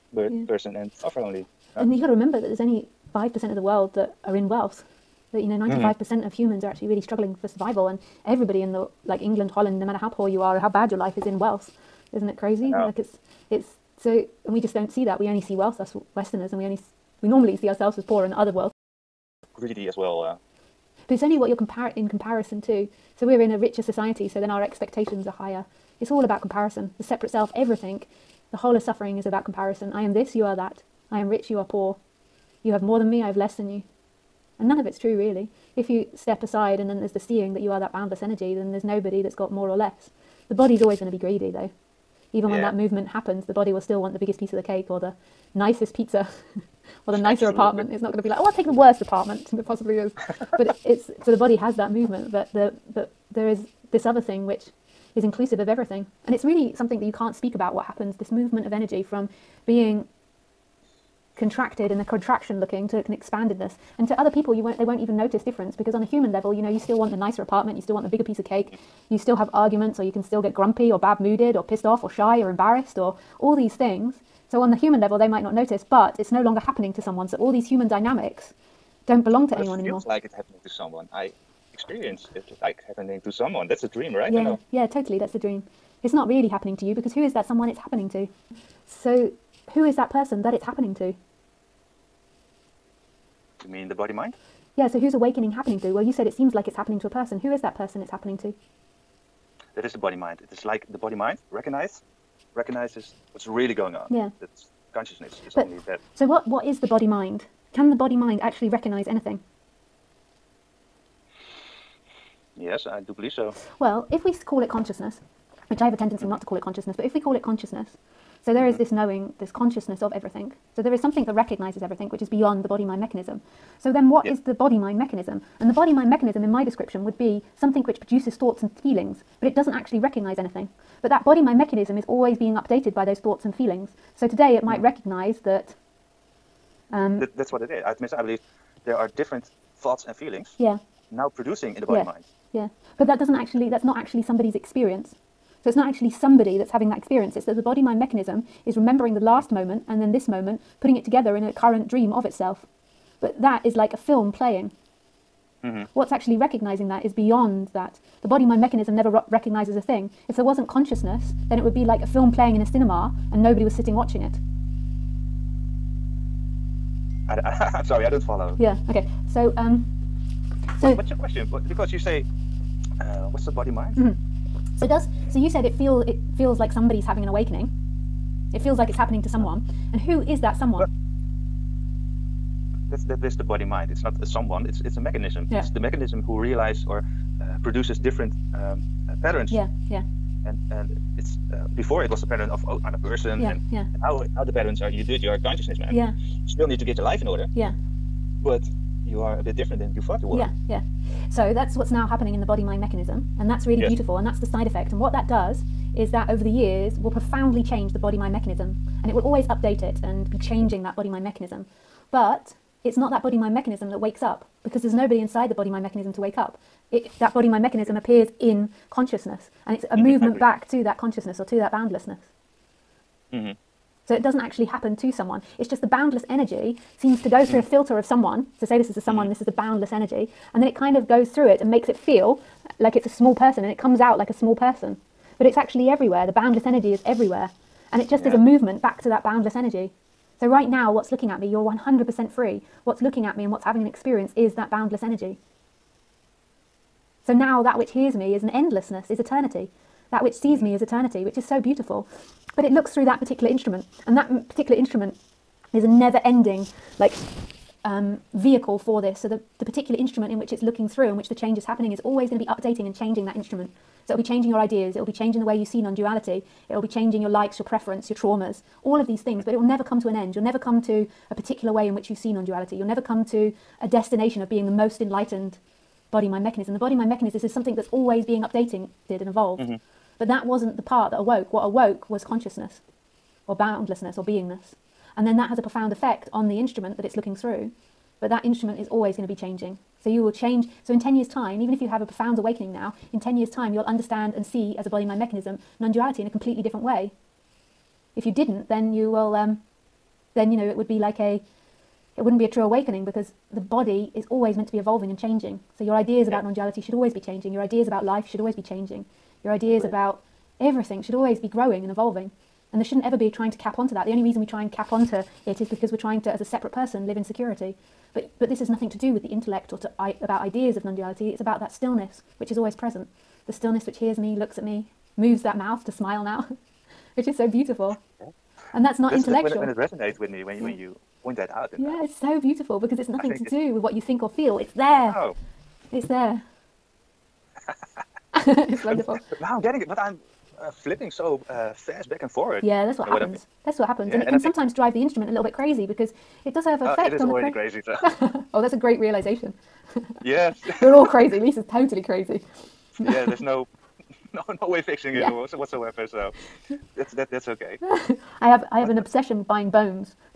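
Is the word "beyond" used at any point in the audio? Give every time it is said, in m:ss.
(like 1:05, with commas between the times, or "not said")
2:02, 2:37.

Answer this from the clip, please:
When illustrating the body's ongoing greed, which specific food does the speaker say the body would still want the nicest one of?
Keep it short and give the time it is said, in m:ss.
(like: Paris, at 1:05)
Pizza, at 0:45.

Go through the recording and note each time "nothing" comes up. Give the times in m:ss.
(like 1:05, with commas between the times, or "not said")
5:18, 5:33.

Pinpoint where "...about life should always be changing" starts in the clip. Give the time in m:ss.
5:07.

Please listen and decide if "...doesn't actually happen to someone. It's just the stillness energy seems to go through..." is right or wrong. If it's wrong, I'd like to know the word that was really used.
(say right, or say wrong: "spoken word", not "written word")
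wrong: "boundless", not "stillness".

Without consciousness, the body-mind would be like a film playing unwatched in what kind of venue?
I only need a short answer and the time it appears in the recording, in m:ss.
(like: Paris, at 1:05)
A cinema, at 2:42.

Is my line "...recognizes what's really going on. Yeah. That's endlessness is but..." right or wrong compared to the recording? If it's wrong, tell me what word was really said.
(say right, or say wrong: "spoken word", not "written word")
wrong: "consciousness", not "endlessness".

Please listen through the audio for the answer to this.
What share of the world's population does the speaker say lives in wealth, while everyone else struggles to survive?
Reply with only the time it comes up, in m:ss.
0:03.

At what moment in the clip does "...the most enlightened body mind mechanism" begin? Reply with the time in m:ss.
4:34.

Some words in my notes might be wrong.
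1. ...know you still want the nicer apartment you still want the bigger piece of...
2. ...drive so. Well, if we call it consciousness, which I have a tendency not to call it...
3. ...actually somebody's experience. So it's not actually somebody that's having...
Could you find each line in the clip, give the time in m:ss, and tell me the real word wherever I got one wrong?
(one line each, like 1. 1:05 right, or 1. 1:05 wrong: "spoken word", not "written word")
1. 1:06 right
2. 1:53 wrong: "believe", not "drive"
3. 2:23 right.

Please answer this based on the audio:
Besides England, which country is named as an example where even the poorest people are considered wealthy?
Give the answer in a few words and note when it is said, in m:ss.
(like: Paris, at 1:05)
Holland, at 0:09.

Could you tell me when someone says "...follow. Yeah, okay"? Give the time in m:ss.
2:48.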